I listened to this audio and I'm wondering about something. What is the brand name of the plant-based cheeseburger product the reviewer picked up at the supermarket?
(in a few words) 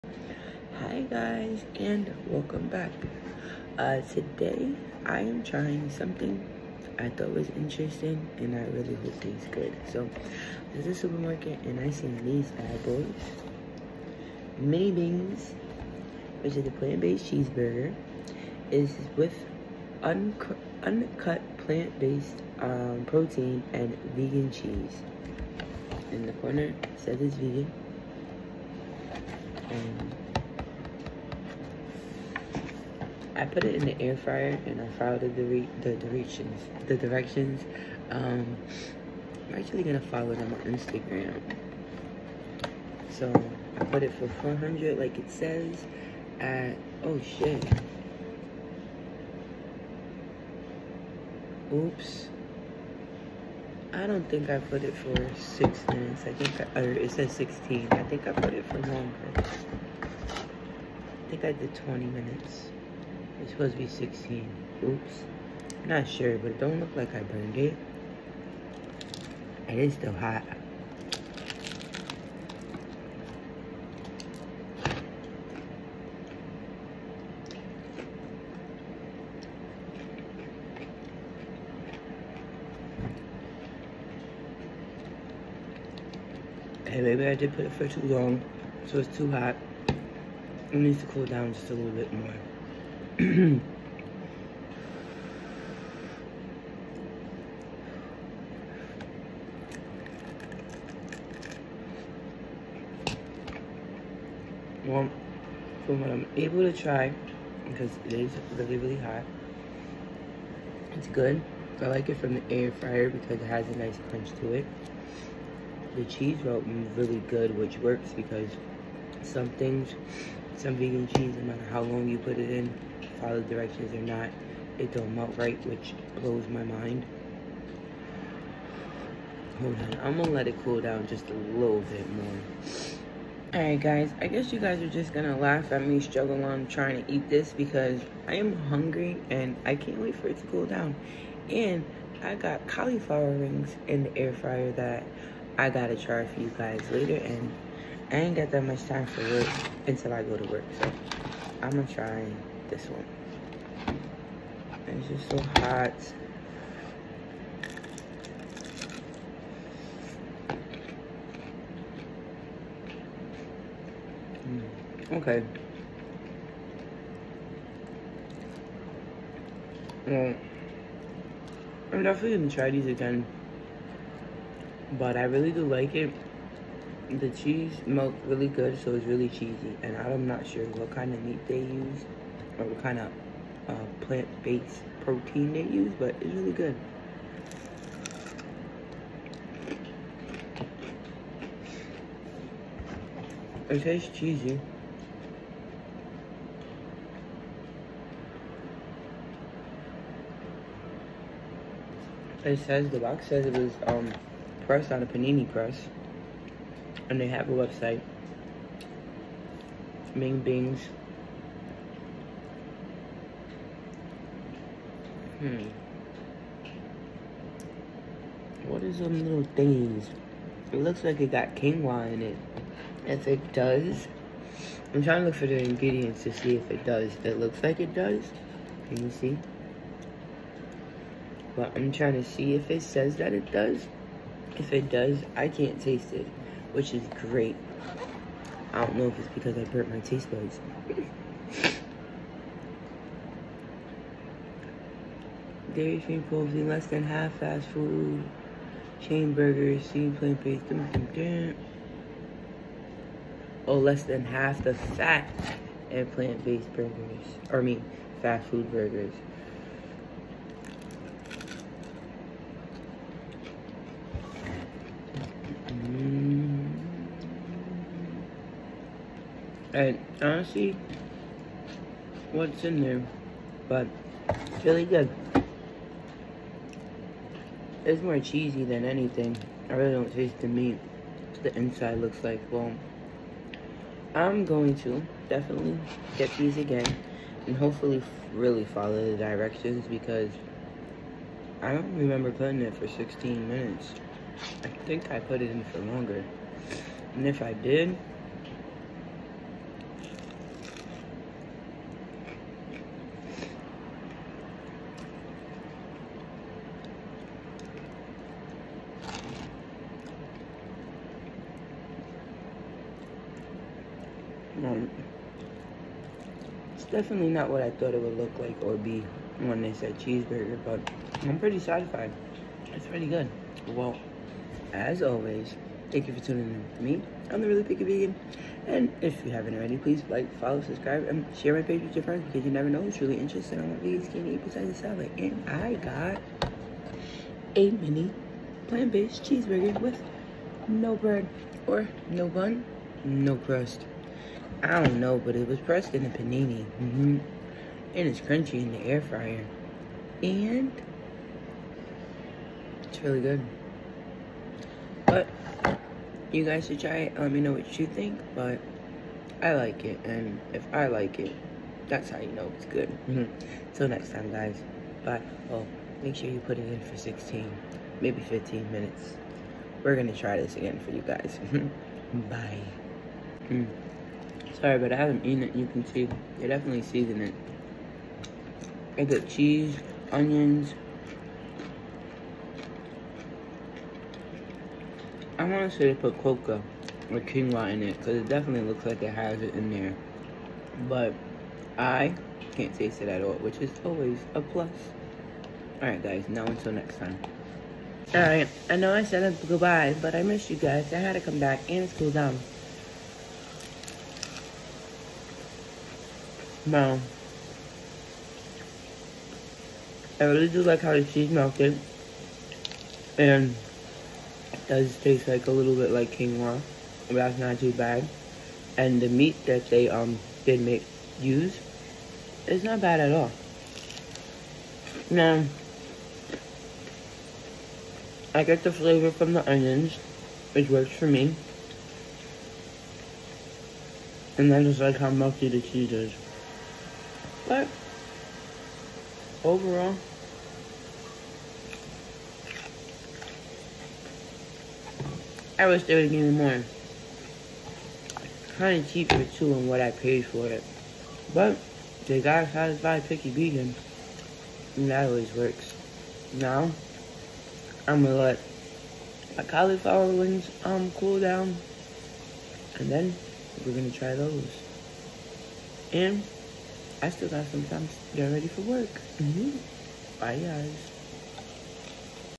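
Mings Bings.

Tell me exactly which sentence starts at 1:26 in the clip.
Hey, maybe I did put it for too long, so it's too hot.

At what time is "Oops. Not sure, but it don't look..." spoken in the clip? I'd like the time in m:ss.
1:04.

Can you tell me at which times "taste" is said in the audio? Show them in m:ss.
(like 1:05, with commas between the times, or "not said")
0:09, 3:13, 3:55, 4:00, 4:40, 6:32, 6:54.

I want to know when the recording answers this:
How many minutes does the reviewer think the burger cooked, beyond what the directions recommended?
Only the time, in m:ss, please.
1:01.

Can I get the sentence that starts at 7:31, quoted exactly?
But they got satisfied picky vegan.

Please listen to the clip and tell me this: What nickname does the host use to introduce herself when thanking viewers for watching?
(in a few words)
the Really Picky Vegan.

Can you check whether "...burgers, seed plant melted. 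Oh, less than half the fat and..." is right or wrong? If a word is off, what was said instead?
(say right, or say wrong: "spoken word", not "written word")
wrong: "based", not "melted".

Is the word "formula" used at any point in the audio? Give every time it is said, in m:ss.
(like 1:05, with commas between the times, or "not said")
not said.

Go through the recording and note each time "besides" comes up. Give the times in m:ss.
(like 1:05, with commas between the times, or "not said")
5:34.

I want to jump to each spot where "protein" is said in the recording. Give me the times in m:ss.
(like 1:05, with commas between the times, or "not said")
0:23, 3:05, 4:06.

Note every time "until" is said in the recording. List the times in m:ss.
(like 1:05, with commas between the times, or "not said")
2:29, 6:36.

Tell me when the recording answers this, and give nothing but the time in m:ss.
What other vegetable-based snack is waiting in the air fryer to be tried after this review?
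7:39.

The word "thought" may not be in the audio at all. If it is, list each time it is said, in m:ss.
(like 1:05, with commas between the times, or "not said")
0:07, 5:17.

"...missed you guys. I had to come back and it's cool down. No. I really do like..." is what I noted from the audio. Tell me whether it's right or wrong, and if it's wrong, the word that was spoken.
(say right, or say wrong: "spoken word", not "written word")
right.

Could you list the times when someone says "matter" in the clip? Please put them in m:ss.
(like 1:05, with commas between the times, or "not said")
2:01.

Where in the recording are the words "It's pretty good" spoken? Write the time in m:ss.
5:22.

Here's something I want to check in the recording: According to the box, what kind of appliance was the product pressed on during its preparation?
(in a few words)
panini press.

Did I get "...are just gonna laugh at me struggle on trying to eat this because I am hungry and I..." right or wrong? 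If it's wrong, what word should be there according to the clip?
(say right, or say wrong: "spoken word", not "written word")
right.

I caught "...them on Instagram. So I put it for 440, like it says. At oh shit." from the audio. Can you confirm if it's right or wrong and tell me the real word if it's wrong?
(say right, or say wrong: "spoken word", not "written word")
wrong: "400", not "440".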